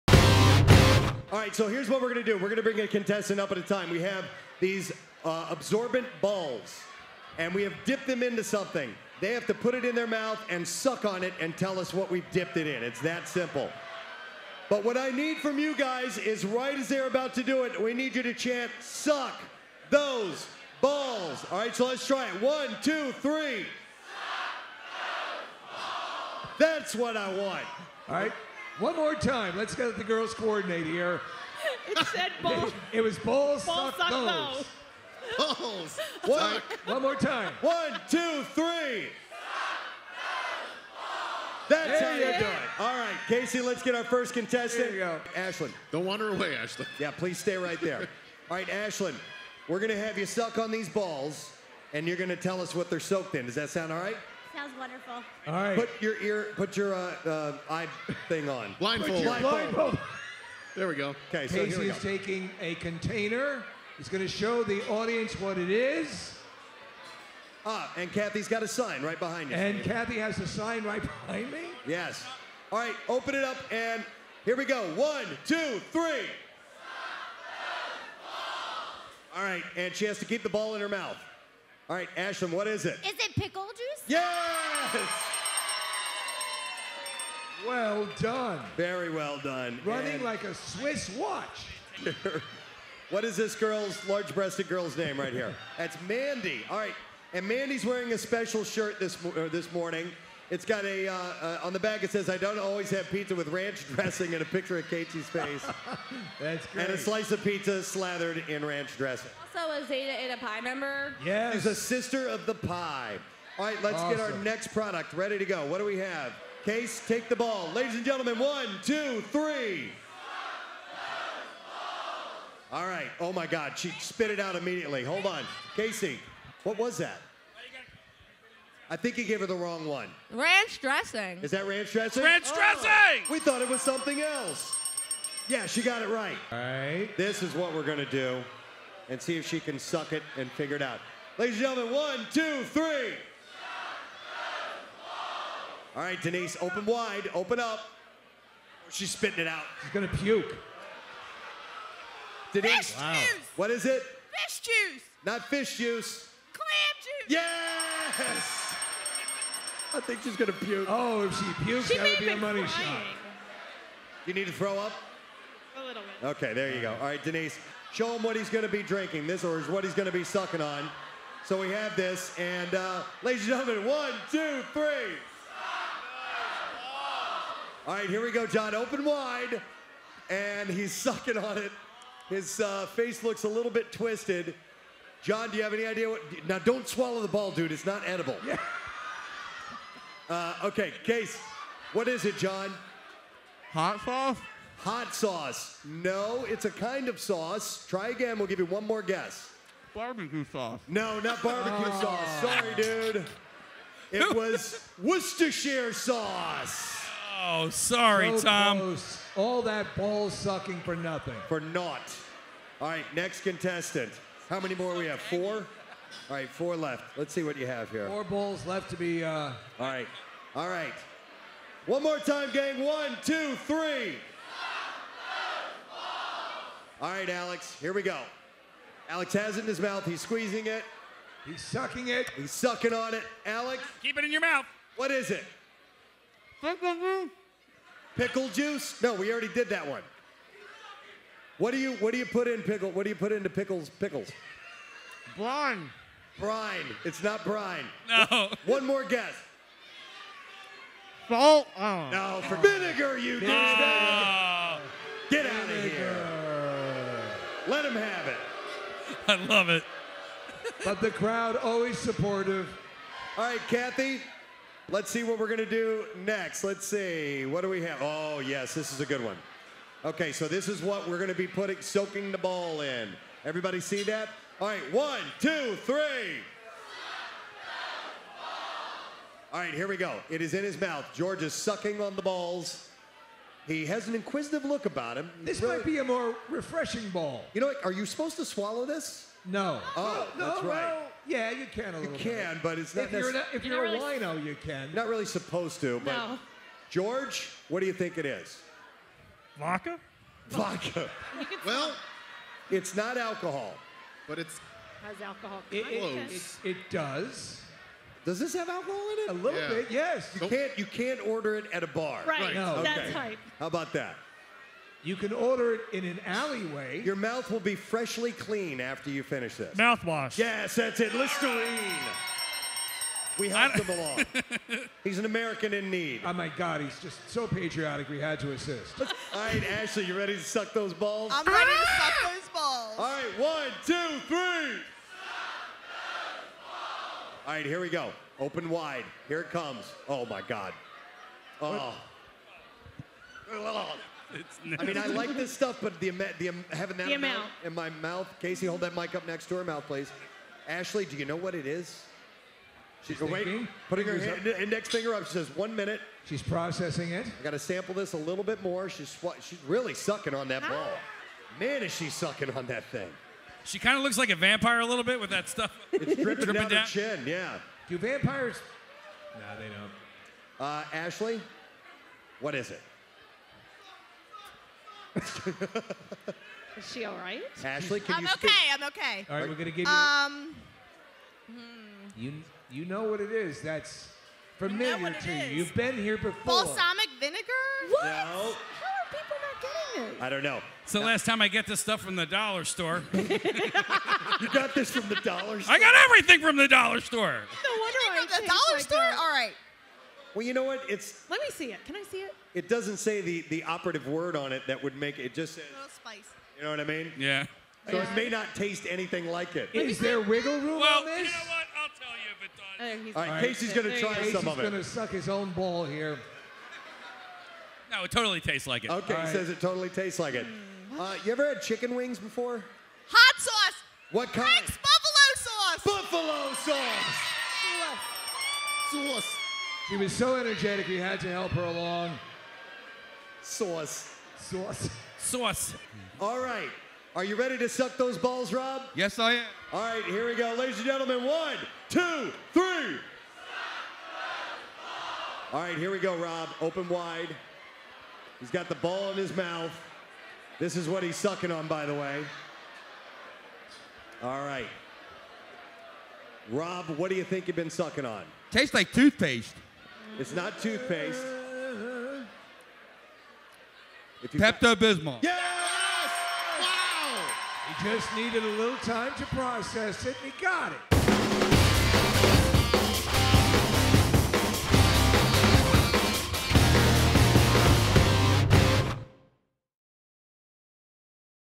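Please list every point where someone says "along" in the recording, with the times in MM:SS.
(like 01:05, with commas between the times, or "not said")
05:23, 07:11.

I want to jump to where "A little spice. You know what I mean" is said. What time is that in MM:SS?
06:45.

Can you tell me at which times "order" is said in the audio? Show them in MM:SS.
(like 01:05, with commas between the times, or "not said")
05:11, 05:15.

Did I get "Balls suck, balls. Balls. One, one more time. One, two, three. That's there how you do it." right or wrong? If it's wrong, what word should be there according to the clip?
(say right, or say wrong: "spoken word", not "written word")
right.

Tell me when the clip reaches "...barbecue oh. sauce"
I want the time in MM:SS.
03:21.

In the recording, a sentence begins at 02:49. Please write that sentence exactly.
This or is what he's going to be sucking on.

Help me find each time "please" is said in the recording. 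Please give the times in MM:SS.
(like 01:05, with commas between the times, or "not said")
00:47, 05:49.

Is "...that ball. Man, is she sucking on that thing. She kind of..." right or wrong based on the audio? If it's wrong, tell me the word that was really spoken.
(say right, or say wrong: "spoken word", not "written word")
right.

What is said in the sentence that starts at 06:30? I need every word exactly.
It's the last time I get this stuff from the dollar store.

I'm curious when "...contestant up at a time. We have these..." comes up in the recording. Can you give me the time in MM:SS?
00:02.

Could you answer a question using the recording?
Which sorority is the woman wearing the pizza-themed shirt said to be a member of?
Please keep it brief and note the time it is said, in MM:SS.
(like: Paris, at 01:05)
Zeta, at 01:49.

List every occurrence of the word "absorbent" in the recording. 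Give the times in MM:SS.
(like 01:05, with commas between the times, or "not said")
00:05.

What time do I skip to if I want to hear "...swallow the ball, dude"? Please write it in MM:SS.
03:06.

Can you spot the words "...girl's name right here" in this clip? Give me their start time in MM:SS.
01:34.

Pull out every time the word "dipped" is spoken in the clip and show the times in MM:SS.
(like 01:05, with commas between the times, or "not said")
00:07, 00:12.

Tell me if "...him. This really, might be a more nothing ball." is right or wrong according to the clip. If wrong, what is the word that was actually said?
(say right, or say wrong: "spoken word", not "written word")
wrong: "refreshing", not "nothing".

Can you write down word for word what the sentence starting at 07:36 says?
Rob, what do you think you've been sucking on?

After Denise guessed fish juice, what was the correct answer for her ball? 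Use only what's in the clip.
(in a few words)
Clam juice.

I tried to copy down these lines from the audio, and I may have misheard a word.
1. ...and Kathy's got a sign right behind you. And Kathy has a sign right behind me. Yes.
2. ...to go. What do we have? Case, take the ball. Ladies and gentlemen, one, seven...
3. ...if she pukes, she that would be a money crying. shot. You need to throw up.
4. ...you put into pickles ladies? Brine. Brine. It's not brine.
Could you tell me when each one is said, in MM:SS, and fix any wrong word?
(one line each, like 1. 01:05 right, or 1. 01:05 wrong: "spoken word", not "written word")
1. 01:07 right
2. 01:55 wrong: "two", not "seven"
3. 02:41 right
4. 04:03 wrong: "pickles", not "ladies".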